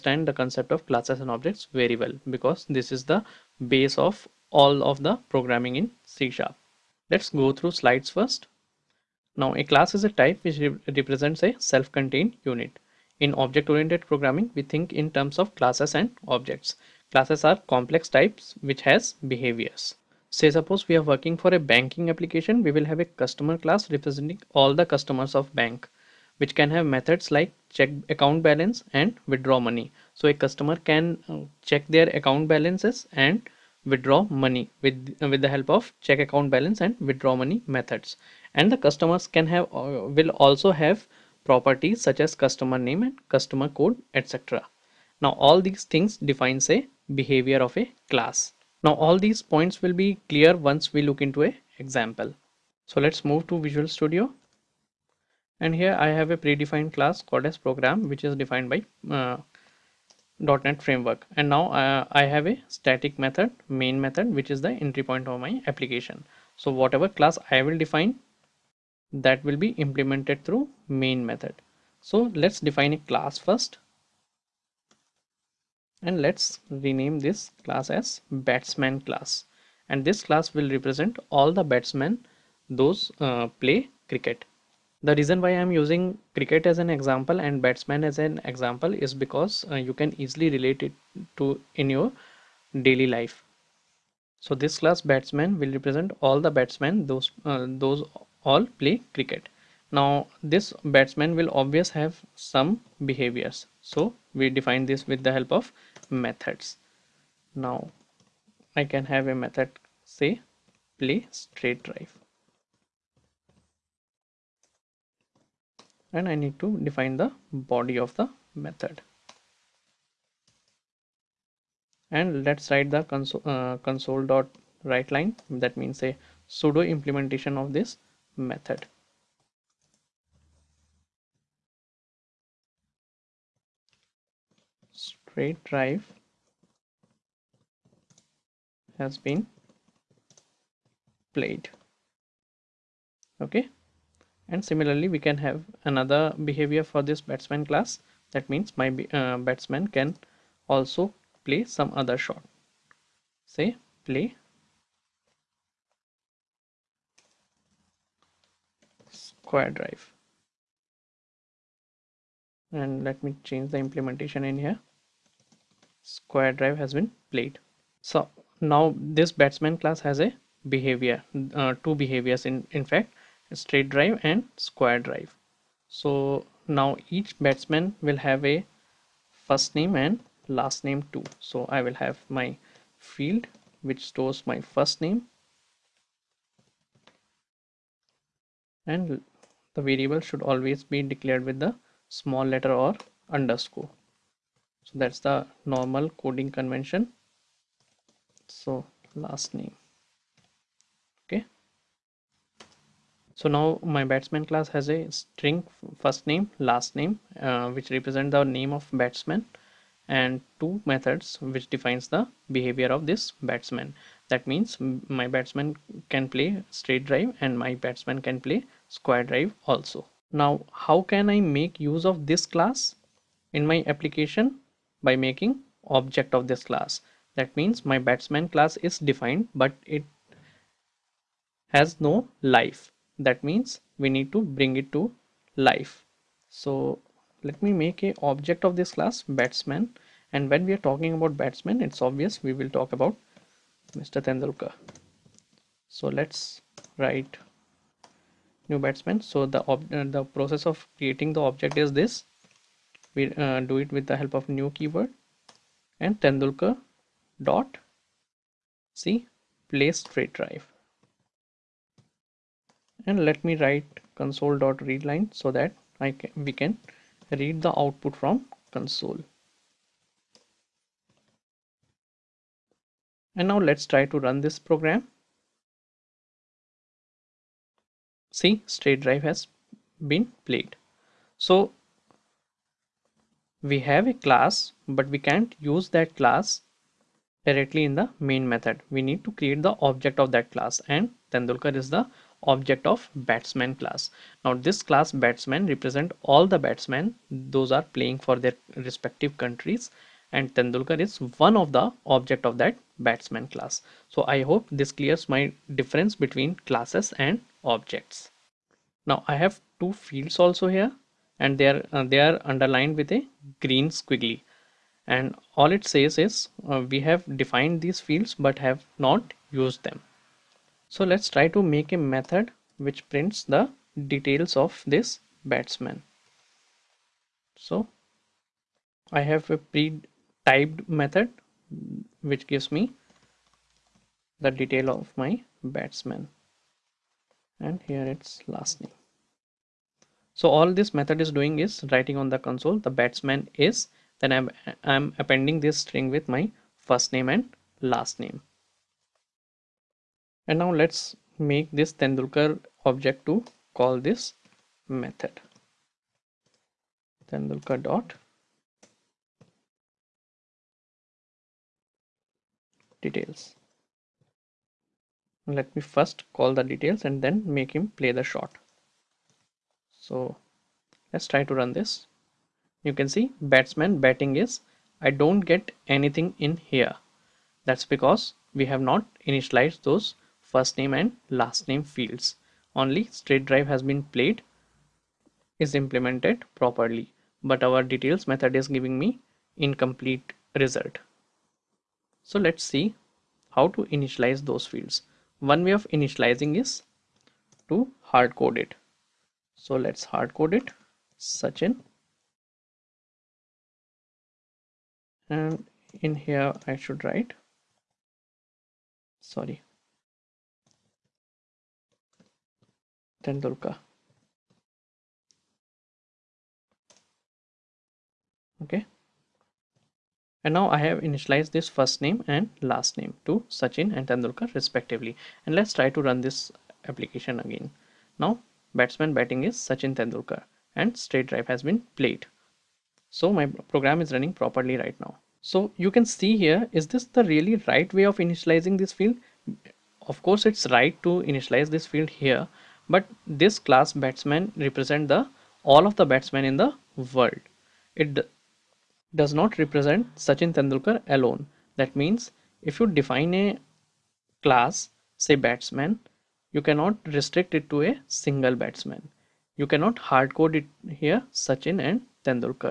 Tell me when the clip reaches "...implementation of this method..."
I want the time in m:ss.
2:06.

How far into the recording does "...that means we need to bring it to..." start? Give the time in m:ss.
3:53.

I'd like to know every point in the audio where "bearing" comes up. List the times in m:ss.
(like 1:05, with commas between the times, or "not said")
not said.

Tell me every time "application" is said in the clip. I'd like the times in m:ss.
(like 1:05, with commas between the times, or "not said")
0:22, 1:05, 3:43, 7:06.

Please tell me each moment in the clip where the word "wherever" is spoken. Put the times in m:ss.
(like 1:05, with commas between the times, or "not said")
not said.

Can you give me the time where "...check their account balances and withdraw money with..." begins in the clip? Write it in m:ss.
0:31.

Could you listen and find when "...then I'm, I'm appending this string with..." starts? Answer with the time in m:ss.
5:44.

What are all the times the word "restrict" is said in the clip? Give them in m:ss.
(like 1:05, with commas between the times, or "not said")
7:37.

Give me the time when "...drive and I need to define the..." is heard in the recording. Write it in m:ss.
1:51.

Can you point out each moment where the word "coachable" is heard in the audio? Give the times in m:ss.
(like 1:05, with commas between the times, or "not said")
not said.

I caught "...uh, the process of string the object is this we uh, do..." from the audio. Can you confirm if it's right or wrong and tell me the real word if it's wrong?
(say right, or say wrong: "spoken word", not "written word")
wrong: "creating", not "string".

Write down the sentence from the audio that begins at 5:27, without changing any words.
So I have a pre-typed method which gives me the detail of my batsman and here it's last name.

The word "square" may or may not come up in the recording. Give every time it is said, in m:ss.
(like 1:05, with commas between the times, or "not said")
2:39, 2:46, 2:54, 3:38.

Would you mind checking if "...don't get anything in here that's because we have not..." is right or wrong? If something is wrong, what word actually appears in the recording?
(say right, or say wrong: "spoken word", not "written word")
right.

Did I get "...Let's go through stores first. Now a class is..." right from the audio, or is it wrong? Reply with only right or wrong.
wrong.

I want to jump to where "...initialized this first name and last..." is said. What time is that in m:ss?
7:00.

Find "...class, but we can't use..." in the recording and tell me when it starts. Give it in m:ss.
4:44.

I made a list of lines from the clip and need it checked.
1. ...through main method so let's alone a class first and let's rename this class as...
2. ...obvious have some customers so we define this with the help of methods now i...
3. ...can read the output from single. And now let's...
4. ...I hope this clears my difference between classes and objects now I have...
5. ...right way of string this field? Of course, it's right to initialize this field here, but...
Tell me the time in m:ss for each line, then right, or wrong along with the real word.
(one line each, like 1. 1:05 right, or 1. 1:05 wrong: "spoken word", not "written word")
1. 1:10 wrong: "define", not "alone"
2. 1:41 wrong: "behaviors", not "customers"
3. 4:26 wrong: "console", not "single"
4. 5:04 right
5. 7:17 wrong: "initializing", not "string".